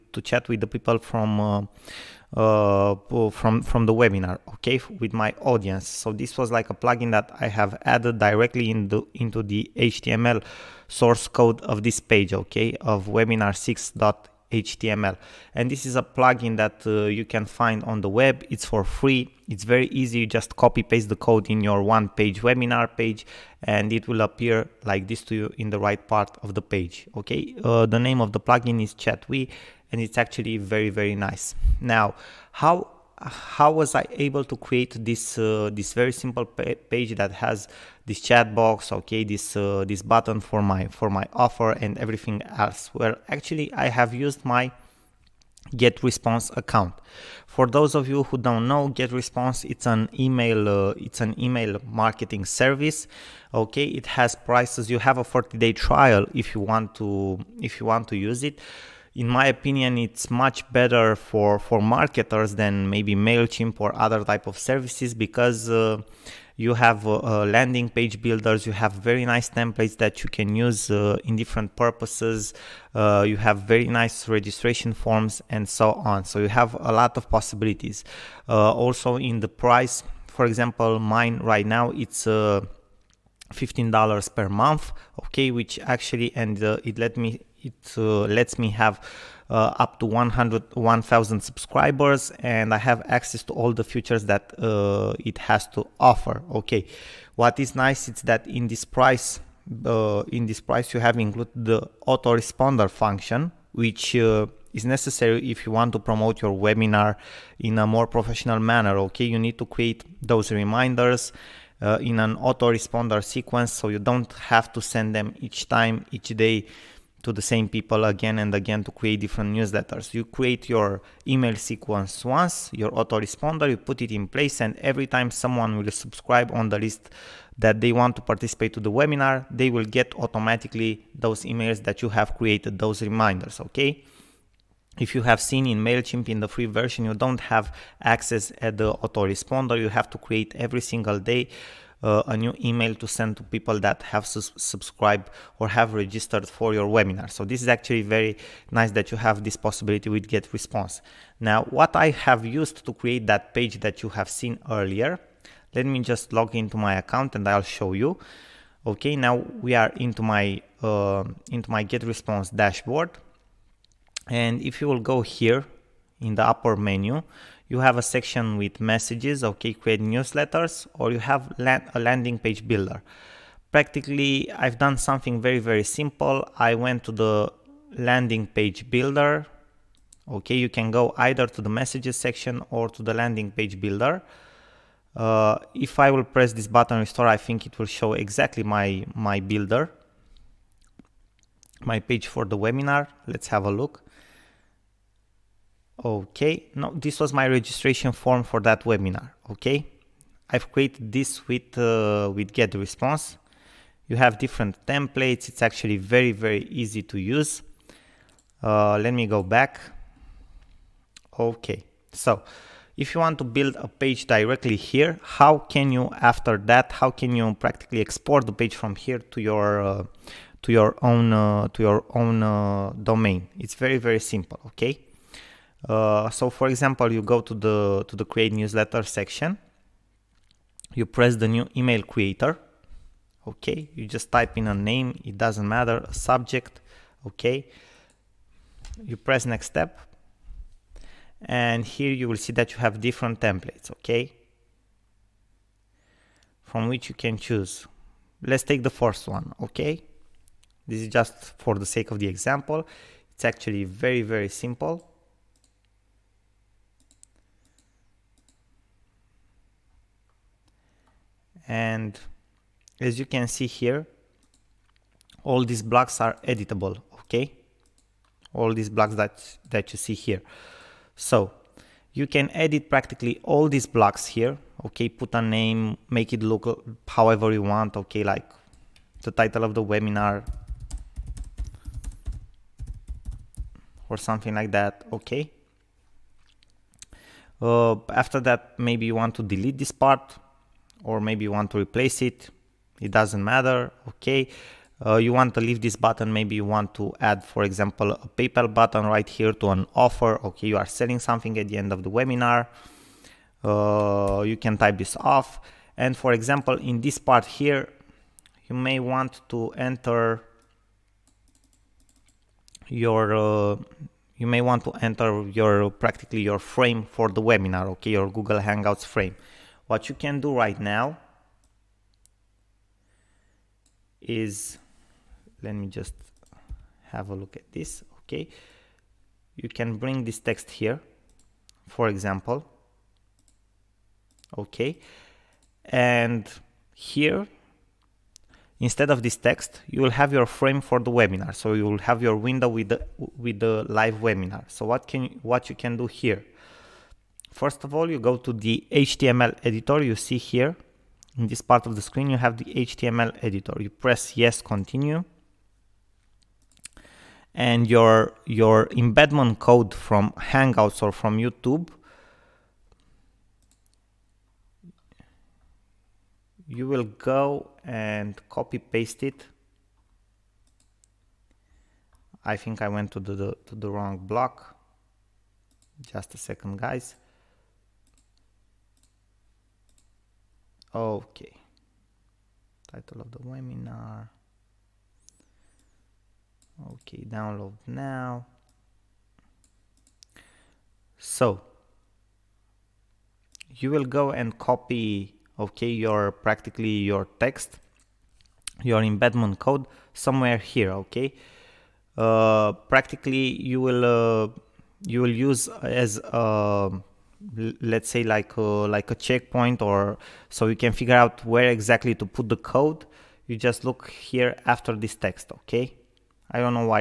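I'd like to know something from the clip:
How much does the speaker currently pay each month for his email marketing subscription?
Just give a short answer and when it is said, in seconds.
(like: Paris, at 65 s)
$15, at 82 s.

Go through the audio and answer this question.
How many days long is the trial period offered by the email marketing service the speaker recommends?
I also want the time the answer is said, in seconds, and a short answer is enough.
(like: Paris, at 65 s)
40 days, at 55 s.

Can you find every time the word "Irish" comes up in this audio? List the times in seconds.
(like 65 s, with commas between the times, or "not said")
not said.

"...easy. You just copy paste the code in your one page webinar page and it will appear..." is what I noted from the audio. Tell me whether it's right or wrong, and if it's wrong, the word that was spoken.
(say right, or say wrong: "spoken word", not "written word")
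right.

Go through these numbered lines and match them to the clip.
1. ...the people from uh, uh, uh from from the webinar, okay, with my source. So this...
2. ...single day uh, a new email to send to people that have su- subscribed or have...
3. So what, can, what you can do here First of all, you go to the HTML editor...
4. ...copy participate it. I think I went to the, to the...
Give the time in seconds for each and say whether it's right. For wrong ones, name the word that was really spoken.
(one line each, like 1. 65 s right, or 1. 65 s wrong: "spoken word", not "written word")
1. 0 s wrong: "audience", not "source"
2. 140 s right
3. 344 s right
4. 368 s wrong: "paste", not "participate".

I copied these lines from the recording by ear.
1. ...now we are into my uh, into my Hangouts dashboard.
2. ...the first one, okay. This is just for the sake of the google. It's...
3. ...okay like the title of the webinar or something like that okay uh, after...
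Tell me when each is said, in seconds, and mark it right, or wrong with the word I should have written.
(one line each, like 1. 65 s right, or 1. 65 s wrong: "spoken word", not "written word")
1. 159 s wrong: "GetResponse", not "Hangouts"
2. 248 s wrong: "example", not "google"
3. 277 s right.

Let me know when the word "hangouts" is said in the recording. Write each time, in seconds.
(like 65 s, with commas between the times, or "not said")
318 s, 360 s.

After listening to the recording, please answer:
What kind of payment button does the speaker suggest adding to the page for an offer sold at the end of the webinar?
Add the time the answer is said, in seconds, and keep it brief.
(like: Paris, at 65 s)
PayPal button, at 298 s.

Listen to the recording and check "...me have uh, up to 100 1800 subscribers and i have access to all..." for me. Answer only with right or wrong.
wrong.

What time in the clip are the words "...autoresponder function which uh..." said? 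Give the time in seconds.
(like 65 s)
102 s.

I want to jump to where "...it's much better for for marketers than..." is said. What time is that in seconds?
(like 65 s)
59 s.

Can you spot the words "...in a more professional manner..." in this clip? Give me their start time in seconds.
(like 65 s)
107 s.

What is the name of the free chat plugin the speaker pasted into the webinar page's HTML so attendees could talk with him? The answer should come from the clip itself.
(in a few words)
Chatwee.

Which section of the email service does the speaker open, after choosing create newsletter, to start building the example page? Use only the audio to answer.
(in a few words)
new email creator.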